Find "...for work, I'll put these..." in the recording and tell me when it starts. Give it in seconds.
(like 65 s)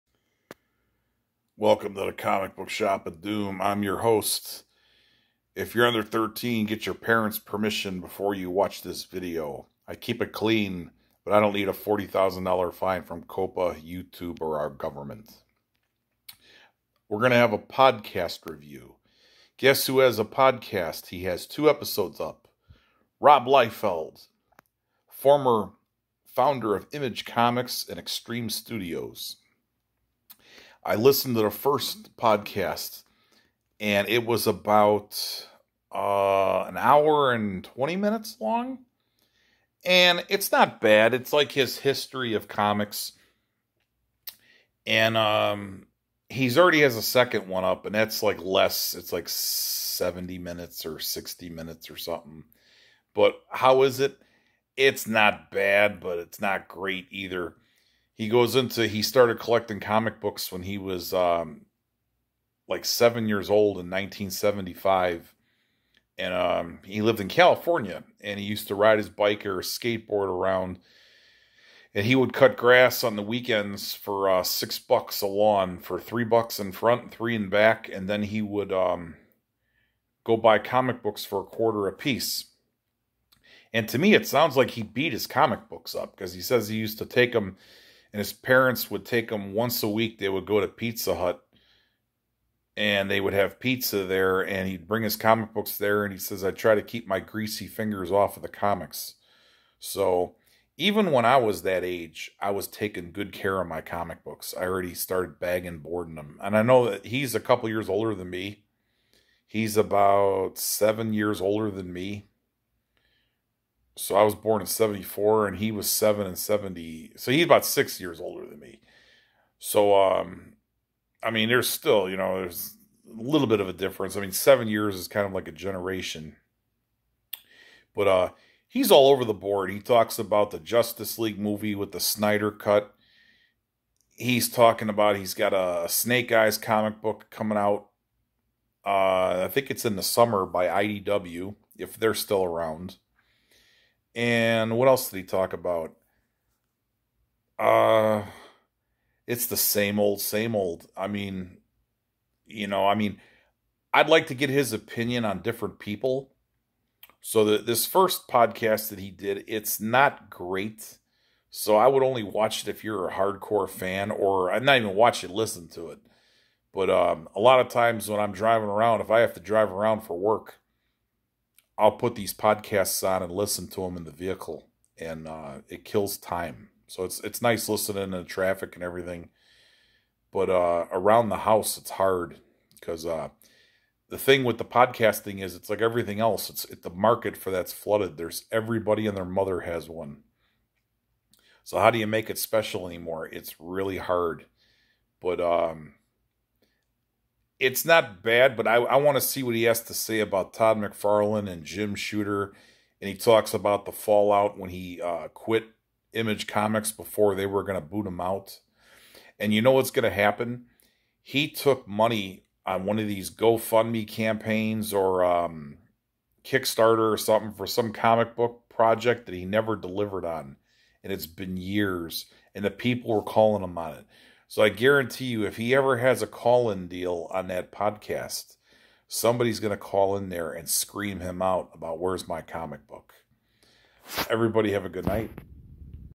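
170 s.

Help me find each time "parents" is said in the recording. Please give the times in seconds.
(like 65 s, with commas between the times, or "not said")
6 s, 88 s.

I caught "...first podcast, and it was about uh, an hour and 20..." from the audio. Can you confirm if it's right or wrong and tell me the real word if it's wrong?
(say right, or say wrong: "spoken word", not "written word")
right.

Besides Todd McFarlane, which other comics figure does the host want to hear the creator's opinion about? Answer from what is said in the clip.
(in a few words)
Jim Shooter.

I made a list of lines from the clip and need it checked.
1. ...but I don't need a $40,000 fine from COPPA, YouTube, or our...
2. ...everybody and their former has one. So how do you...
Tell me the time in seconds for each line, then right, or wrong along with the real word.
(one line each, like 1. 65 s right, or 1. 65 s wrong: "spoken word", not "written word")
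1. 11 s right
2. 188 s wrong: "mother", not "former".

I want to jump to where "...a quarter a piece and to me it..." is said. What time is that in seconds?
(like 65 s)
81 s.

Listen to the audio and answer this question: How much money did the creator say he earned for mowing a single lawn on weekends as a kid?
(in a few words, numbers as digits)
$6.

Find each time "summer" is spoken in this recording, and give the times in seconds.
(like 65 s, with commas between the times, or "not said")
140 s.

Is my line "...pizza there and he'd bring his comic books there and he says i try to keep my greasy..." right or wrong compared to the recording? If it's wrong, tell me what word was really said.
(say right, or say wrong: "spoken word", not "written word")
right.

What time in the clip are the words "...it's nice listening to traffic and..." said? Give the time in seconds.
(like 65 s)
177 s.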